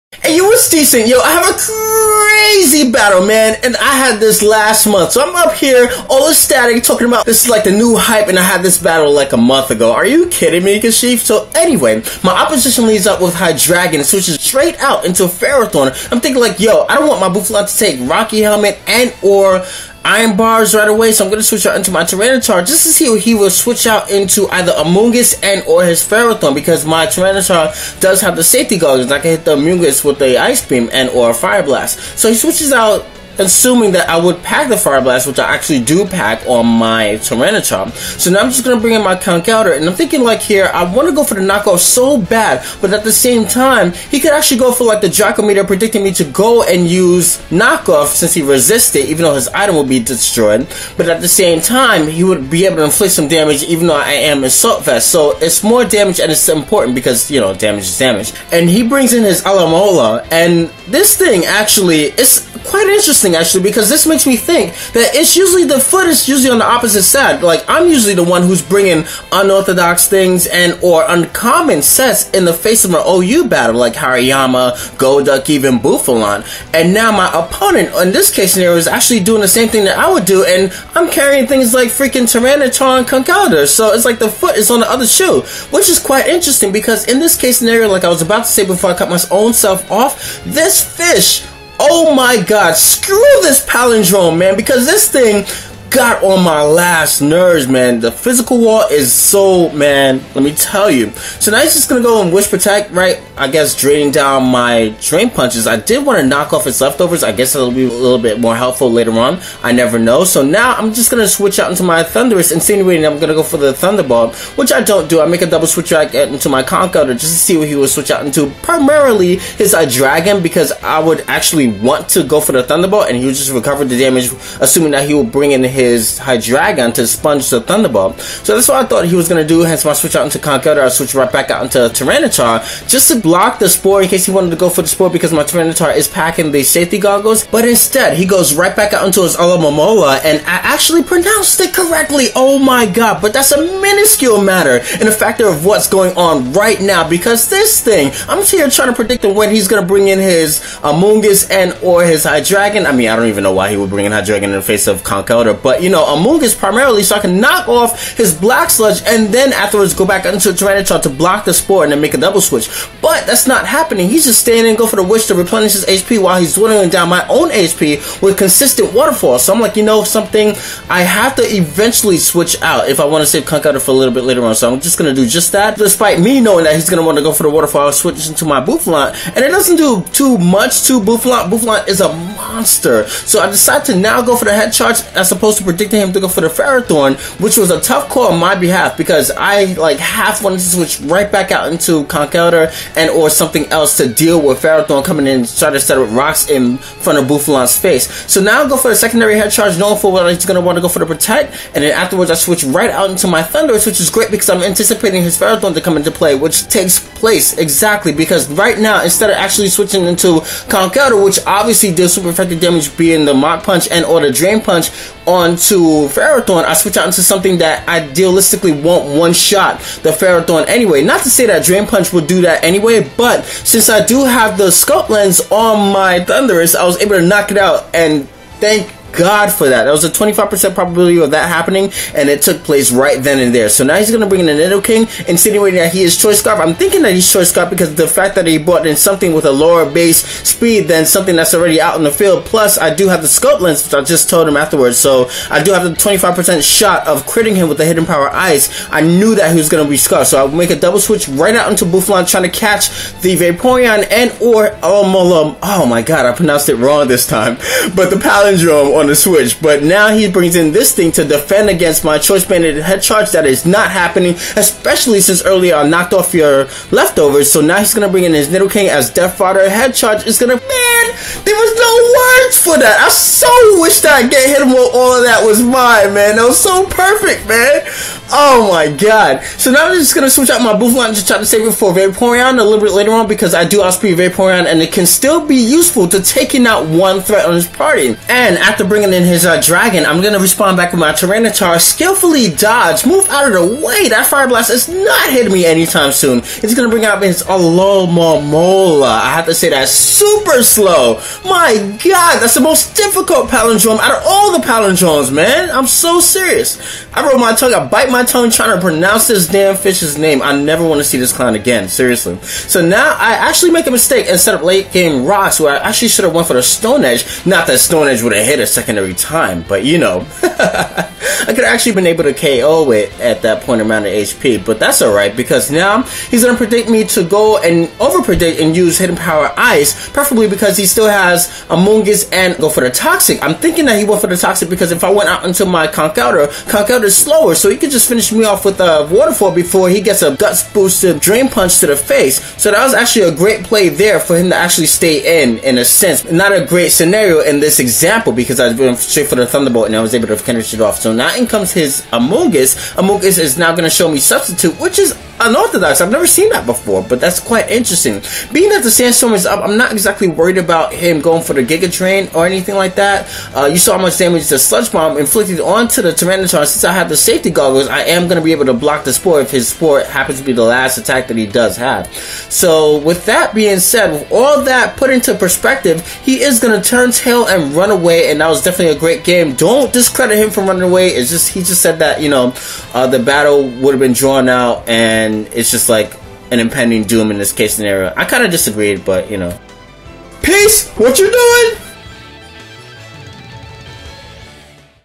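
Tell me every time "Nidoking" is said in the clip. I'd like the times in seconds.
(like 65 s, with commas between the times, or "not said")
234 s, 268 s.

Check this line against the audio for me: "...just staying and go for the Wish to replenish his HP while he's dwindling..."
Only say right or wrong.
right.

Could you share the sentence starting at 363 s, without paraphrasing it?
Uh, you saw how much damage the Sludge Bomb inflicted onto the Tyranitar.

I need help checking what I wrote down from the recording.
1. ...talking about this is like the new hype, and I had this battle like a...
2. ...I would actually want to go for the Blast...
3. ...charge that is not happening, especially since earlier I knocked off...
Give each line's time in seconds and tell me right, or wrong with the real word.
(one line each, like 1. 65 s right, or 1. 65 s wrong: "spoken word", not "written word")
1. 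6 s right
2. 120 s wrong: "Thunderbolt", not "Blast"
3. 263 s right.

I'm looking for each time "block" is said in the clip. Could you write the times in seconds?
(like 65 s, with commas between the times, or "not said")
133 s, 161 s, 368 s.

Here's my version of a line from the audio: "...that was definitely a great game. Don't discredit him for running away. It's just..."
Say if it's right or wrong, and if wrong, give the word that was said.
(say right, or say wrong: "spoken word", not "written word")
right.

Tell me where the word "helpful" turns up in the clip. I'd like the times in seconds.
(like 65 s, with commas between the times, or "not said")
108 s.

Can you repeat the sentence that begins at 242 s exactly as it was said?
Plus, I do have the scope lens, which I just told him afterwards.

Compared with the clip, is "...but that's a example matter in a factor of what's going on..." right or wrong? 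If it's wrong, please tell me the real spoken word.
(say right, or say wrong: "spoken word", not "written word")
wrong: "minuscule", not "example".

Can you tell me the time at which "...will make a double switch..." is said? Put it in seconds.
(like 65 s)
250 s.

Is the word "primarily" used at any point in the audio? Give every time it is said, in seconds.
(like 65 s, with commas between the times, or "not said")
118 s, 156 s.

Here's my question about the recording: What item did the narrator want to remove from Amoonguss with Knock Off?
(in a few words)
Black Sludge.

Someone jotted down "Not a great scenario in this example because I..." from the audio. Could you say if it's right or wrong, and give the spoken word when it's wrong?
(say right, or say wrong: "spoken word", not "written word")
right.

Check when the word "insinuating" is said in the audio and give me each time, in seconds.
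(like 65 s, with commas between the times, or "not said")
112 s, 235 s.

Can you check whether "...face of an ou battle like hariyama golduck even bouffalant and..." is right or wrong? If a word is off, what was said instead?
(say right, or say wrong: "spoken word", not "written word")
right.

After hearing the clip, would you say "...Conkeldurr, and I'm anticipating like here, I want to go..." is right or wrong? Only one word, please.
wrong.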